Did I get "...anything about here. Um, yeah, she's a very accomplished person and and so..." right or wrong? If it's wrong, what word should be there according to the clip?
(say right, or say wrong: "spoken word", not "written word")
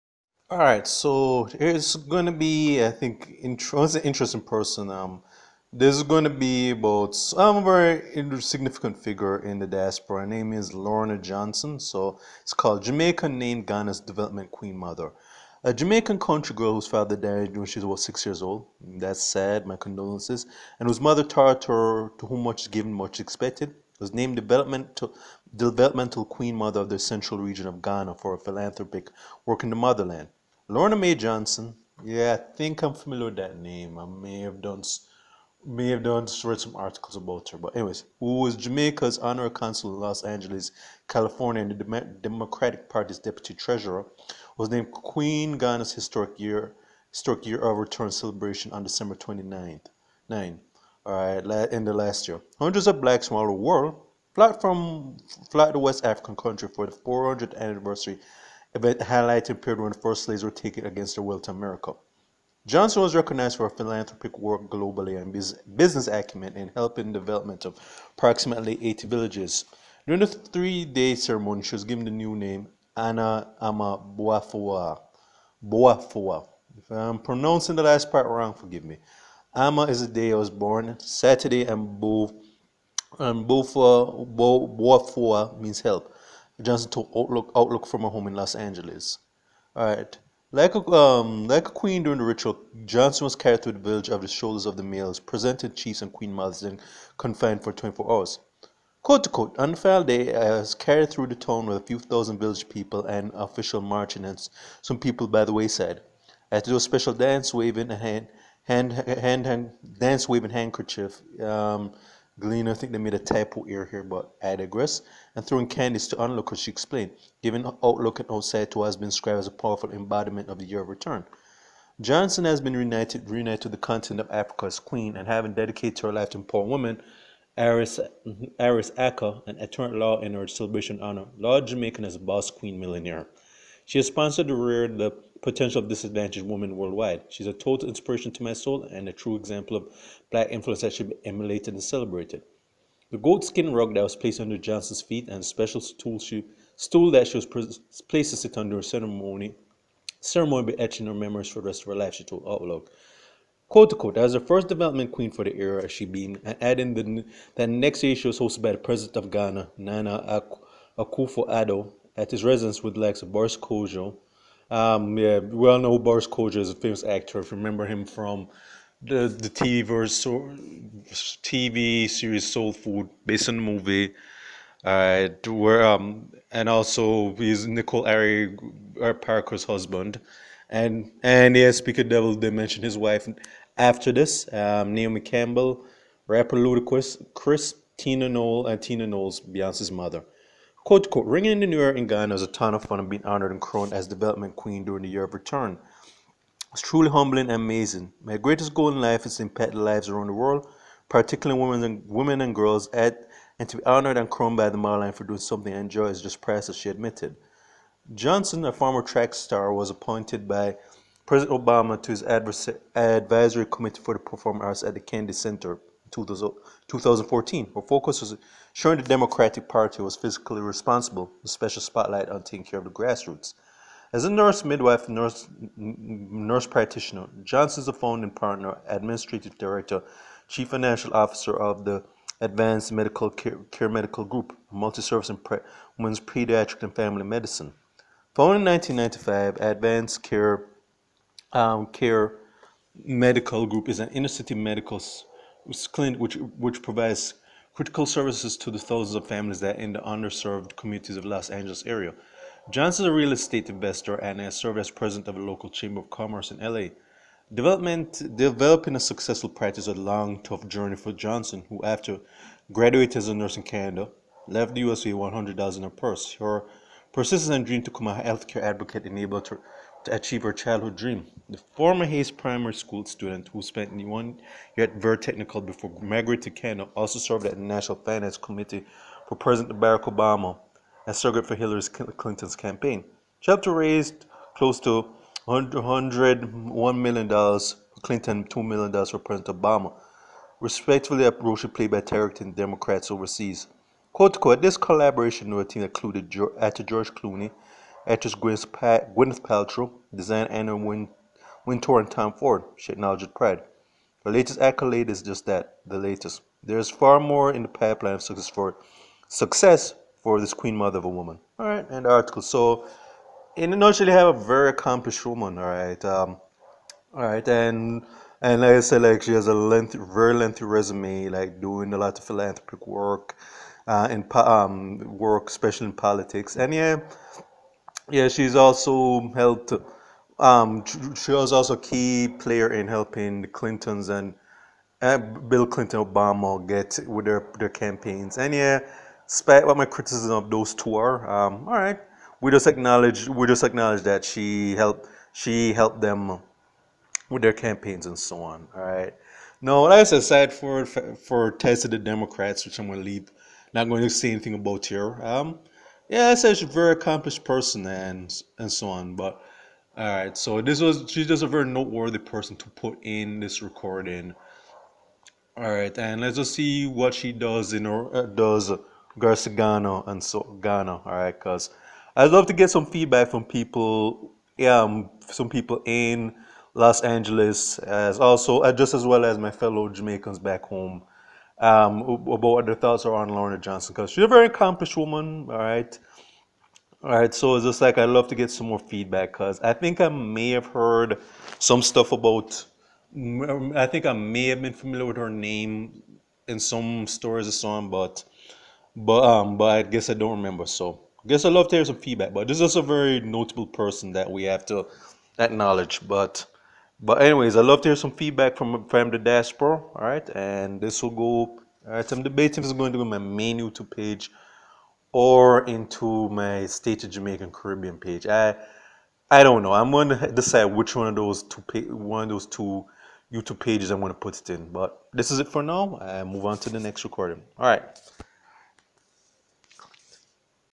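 right.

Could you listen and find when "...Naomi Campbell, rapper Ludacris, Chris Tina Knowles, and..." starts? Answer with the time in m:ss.
3:04.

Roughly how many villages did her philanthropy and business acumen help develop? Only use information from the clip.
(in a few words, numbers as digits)
80.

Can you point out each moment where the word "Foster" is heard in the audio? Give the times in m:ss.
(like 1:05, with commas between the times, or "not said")
not said.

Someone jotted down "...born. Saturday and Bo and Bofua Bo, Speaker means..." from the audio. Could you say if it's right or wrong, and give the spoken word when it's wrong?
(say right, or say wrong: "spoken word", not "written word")
wrong: "Boafua", not "Speaker".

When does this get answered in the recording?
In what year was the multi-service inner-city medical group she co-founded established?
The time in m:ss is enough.
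3:58.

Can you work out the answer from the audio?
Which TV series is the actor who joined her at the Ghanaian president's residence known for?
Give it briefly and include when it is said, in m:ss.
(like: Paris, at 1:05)
Soul Food, at 2:52.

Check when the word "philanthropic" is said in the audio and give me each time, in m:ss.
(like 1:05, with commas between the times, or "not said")
0:28, 1:03, 5:22.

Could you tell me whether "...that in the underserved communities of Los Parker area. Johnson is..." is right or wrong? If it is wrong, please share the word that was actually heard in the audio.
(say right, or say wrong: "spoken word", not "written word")
wrong: "Angeles", not "Parker".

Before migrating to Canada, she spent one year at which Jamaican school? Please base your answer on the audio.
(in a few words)
Vere Technical.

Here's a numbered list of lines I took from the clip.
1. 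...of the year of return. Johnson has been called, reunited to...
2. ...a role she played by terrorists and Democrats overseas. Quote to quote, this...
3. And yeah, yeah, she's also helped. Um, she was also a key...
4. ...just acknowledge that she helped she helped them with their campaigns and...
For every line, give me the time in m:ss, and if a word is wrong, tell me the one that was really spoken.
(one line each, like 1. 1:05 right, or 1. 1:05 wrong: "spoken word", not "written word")
1. 2:00 wrong: "reunited", not "called"
2. 4:51 right
3. 5:26 right
4. 5:43 right.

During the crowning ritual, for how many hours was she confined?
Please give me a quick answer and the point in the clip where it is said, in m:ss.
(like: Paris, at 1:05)
24 hours, at 1:37.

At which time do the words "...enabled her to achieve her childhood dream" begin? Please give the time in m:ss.
4:29.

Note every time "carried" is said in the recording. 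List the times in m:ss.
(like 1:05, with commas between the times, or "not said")
1:33, 1:40.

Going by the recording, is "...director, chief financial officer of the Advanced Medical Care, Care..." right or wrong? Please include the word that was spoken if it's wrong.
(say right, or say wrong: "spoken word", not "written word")
right.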